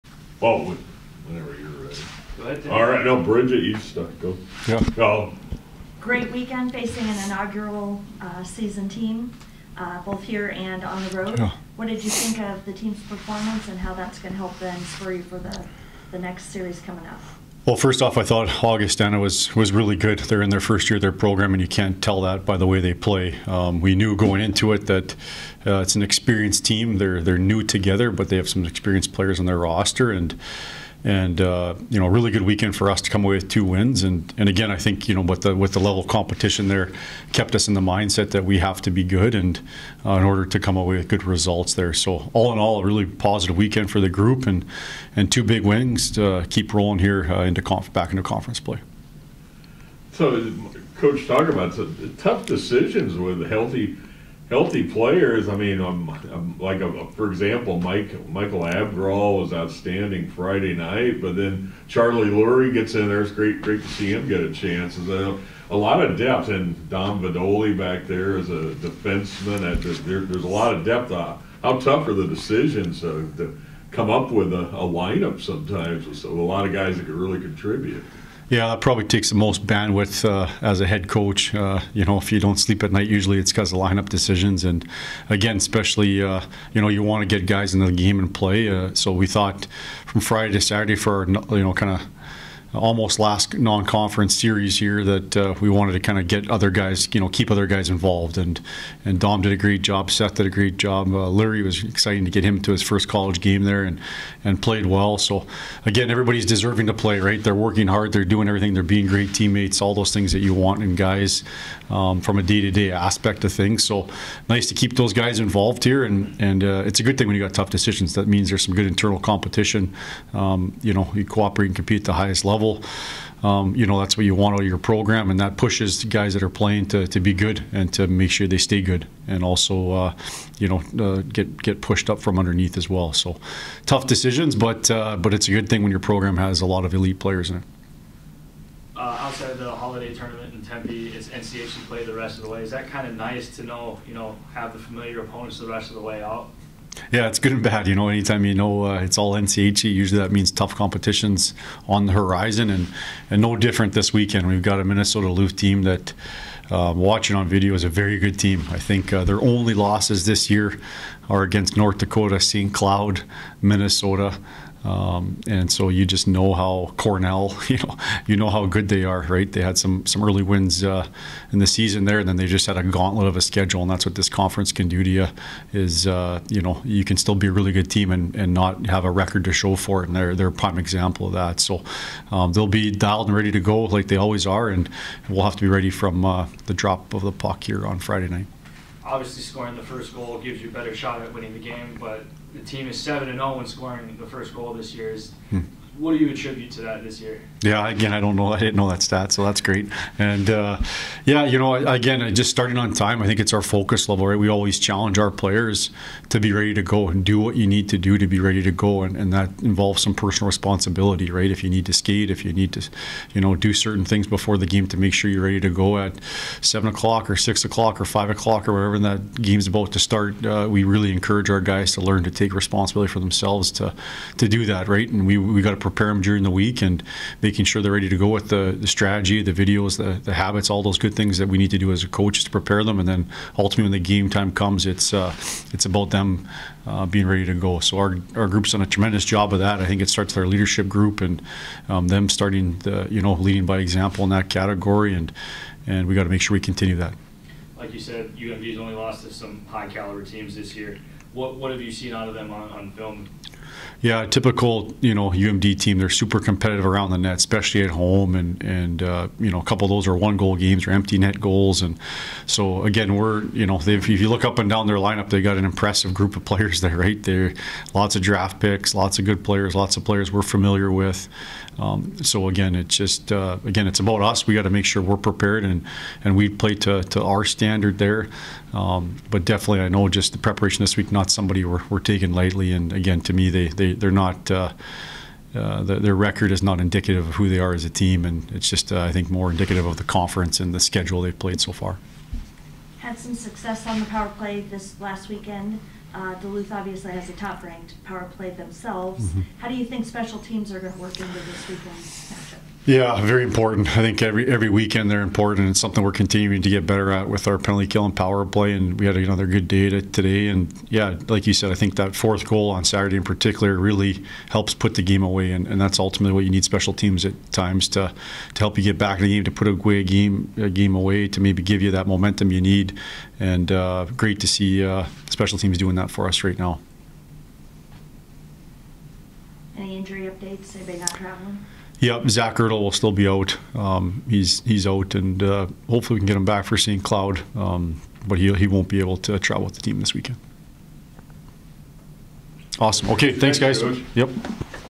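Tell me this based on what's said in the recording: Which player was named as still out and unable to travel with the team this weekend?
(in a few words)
Zach Urdahl.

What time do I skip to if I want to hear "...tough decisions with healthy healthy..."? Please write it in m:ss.
0:52.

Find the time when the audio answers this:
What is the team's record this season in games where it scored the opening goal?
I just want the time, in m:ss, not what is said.
3:12.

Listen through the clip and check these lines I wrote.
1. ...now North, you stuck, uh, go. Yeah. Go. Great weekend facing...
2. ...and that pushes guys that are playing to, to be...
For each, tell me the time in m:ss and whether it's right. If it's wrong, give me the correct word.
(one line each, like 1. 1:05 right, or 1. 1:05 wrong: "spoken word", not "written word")
1. 0:03 wrong: "Bridget", not "North"
2. 2:05 right.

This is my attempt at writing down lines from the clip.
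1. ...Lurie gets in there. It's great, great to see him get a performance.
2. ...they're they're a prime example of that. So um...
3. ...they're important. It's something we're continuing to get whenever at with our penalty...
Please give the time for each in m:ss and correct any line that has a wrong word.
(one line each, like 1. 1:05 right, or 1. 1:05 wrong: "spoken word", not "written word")
1. 1:02 wrong: "chance", not "performance"
2. 3:00 right
3. 5:05 wrong: "better", not "whenever".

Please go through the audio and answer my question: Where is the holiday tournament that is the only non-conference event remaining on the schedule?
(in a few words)
Tempe.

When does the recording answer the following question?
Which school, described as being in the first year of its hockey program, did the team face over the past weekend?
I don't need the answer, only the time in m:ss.
0:18.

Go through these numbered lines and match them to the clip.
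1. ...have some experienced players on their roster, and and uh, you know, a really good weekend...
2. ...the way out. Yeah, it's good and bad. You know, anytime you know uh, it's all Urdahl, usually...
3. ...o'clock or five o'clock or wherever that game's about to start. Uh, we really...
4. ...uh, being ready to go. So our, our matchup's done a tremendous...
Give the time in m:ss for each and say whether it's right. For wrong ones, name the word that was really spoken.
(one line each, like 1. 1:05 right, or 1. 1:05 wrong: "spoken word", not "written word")
1. 0:28 right
2. 2:25 wrong: "NCHC", not "Urdahl"
3. 3:37 right
4. 3:56 wrong: "group", not "matchup".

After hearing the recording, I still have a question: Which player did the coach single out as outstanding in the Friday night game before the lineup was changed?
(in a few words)
Michael Abgrall.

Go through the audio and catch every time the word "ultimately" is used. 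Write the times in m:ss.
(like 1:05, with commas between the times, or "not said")
3:53, 5:15.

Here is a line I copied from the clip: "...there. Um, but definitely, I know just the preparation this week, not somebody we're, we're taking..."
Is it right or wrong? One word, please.
right.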